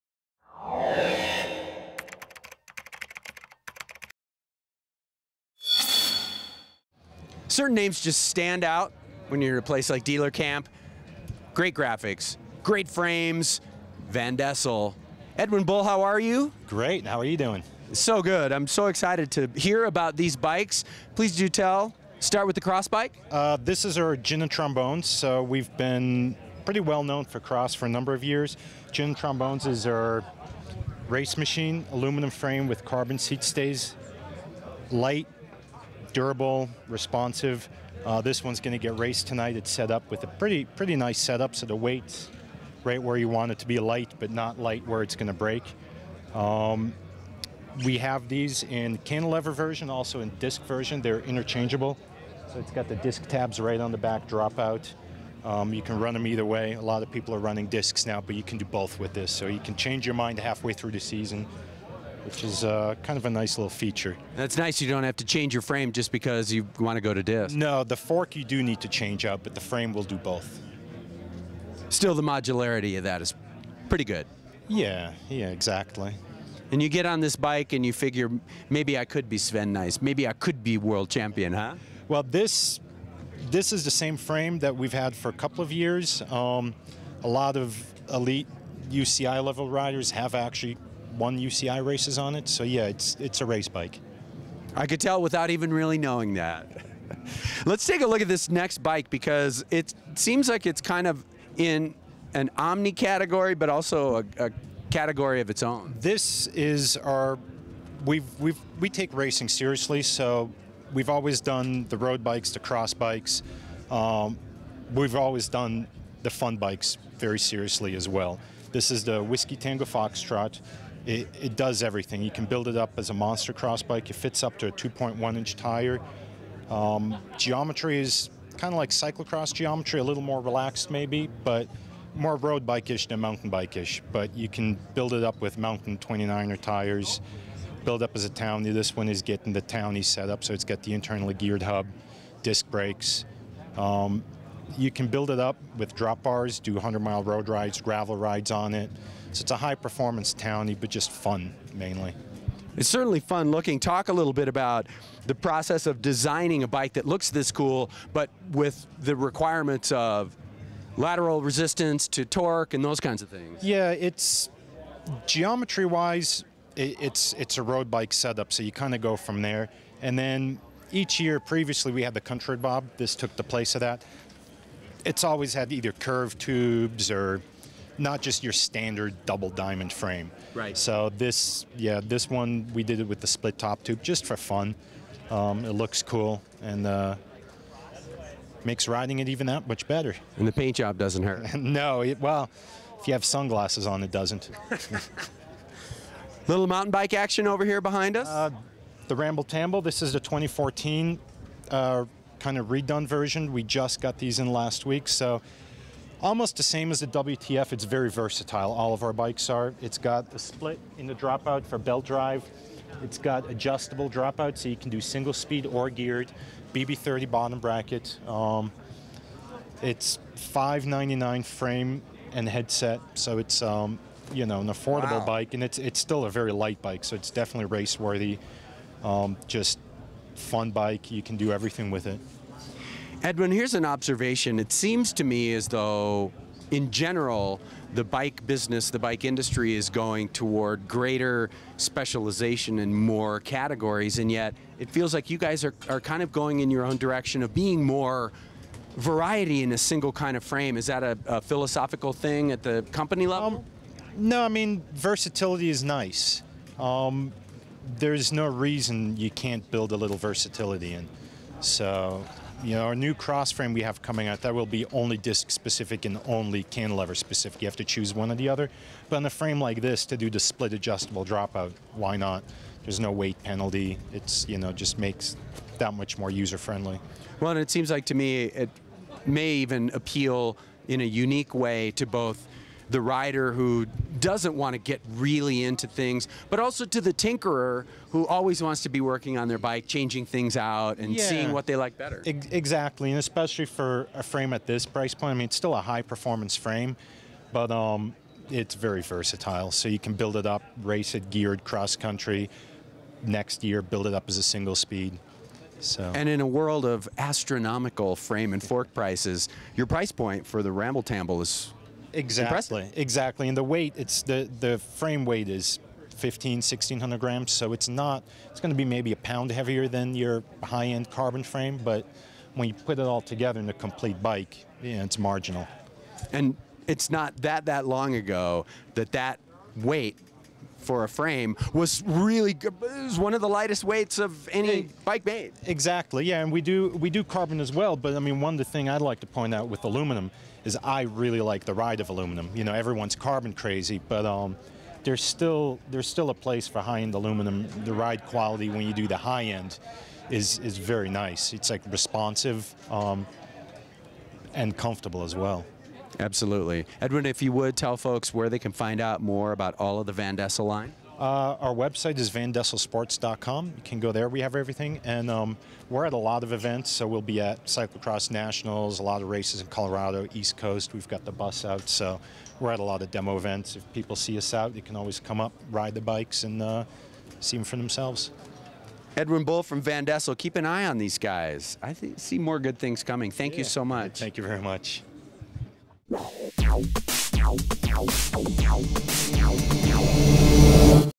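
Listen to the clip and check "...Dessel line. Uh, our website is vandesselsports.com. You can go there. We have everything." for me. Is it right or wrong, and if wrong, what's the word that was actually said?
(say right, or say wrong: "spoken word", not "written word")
right.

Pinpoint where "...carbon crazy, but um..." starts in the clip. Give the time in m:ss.
5:43.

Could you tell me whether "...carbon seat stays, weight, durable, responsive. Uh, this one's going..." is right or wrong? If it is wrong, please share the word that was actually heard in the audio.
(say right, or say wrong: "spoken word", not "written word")
wrong: "light", not "weight".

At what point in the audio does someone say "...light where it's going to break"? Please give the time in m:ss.
0:44.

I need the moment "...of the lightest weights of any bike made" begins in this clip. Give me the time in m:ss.
5:33.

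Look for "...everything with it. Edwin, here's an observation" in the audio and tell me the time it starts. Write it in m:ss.
3:51.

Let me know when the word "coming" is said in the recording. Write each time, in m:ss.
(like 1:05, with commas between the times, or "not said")
4:24, 6:23.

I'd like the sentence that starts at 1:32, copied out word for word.
So yeah, it's it's a race bike.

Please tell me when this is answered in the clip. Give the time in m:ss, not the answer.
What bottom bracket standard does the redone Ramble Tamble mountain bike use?
3:36.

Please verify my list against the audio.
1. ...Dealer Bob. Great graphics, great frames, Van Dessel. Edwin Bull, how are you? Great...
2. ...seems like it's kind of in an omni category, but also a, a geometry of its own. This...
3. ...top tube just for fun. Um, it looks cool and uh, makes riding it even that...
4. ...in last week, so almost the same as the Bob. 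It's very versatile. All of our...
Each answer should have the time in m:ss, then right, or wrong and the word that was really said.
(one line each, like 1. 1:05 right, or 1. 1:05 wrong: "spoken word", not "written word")
1. 0:10 wrong: "Camp", not "Bob"
2. 1:40 wrong: "category", not "geometry"
3. 3:03 right
4. 3:24 wrong: "WTF", not "Bob".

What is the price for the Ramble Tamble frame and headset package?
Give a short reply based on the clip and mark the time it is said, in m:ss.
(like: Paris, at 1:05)
599, at 3:40.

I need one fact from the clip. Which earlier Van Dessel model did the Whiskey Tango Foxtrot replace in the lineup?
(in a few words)
Country Bob.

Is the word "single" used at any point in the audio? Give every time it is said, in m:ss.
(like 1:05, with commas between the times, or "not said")
3:34, 4:09, 5:04.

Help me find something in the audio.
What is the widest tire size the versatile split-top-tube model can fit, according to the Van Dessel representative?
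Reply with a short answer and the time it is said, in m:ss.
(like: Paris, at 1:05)
2.1 inch, at 2:04.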